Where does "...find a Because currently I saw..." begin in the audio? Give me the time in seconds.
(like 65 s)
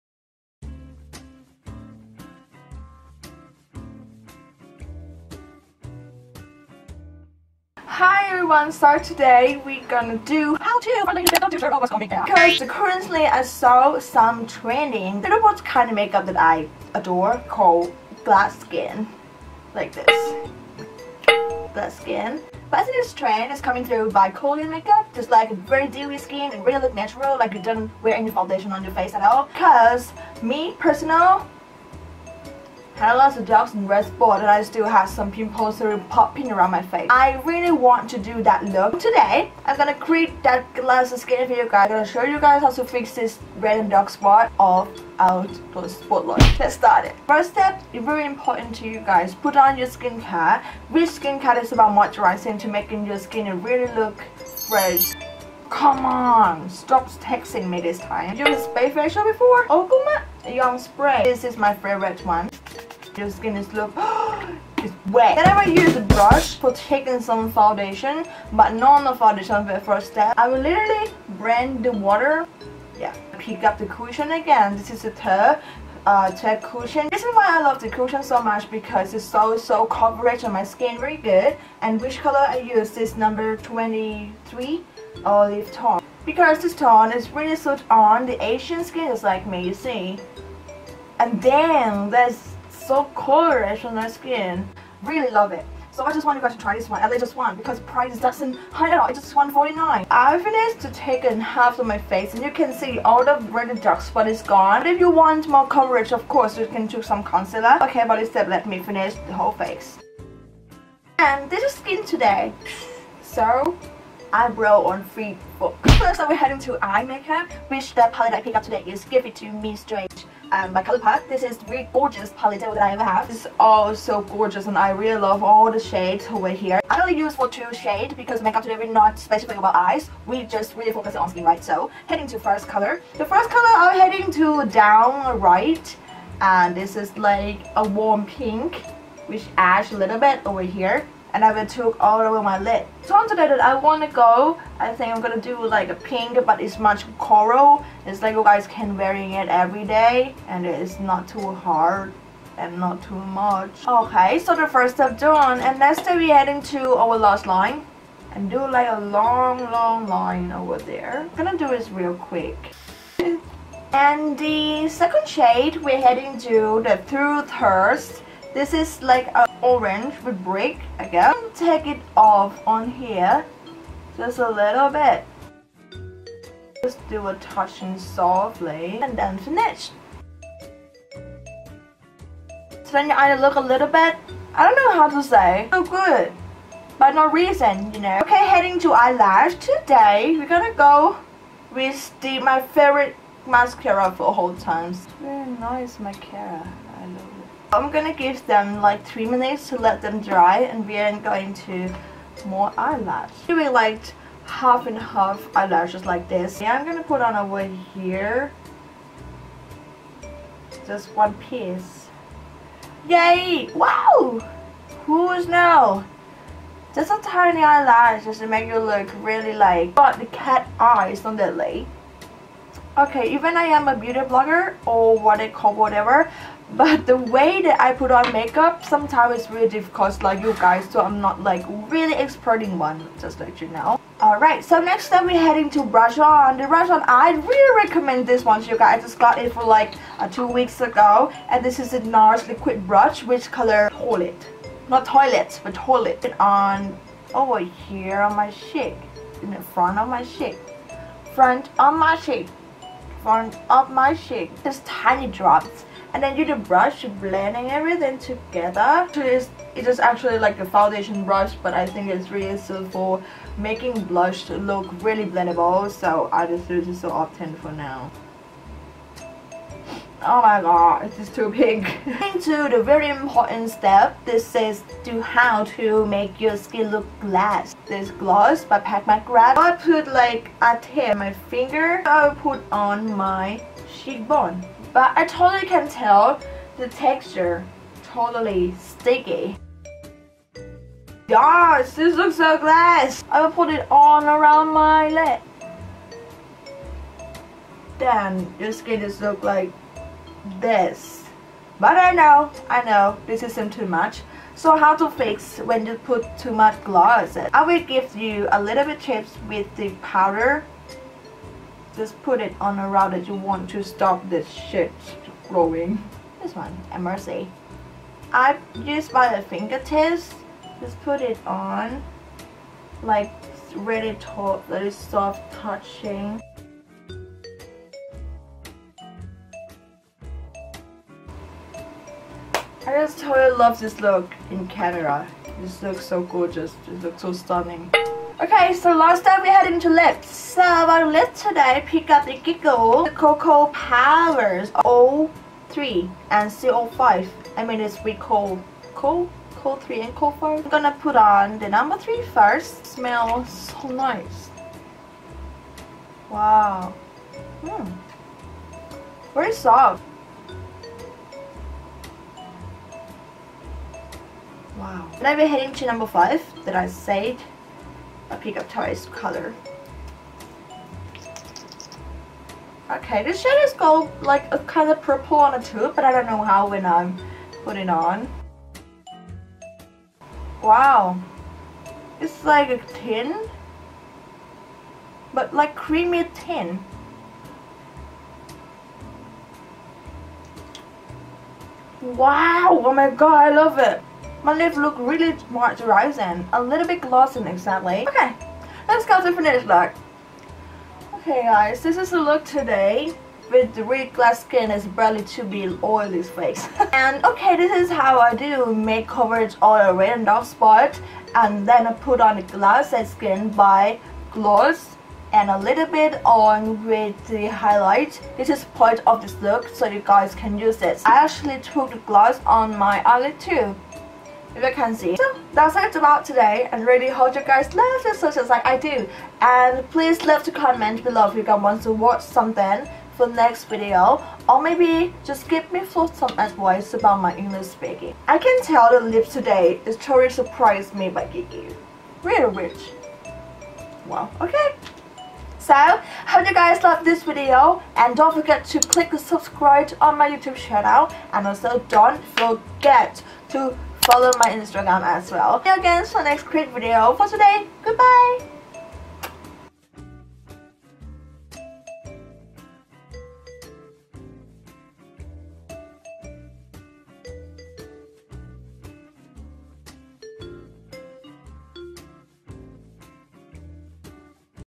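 11 s.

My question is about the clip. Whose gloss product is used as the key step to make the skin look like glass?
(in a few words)
Pat McGrath.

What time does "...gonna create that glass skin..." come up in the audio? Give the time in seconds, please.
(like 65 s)
39 s.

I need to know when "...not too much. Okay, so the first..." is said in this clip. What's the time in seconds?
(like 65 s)
152 s.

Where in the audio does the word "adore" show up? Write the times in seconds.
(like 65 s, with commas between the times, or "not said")
16 s.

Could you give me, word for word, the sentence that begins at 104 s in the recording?
But if you want more coverage, of course, you can choose some concealer.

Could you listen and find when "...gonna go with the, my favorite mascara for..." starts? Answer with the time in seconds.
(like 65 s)
190 s.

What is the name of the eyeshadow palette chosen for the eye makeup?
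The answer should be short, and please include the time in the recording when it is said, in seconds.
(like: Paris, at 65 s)
Give It To Me Straight, at 119 s.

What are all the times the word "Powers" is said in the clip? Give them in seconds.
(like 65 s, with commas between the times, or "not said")
343 s.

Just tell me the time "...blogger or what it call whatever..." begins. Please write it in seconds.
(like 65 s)
224 s.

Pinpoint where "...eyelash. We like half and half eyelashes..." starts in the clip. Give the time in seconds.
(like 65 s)
202 s.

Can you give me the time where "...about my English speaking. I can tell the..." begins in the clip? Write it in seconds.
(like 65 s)
436 s.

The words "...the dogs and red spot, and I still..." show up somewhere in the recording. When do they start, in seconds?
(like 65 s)
33 s.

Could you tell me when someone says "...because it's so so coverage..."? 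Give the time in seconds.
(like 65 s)
78 s.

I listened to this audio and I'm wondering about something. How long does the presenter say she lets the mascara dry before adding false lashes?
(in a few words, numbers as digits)
3 minutes.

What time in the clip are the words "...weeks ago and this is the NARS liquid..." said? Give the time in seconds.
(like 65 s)
240 s.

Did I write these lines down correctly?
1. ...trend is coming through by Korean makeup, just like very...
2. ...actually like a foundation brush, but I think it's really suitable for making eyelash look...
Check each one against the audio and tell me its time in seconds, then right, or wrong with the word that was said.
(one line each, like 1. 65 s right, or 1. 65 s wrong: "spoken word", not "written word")
1. 23 s right
2. 260 s wrong: "blush", not "eyelash".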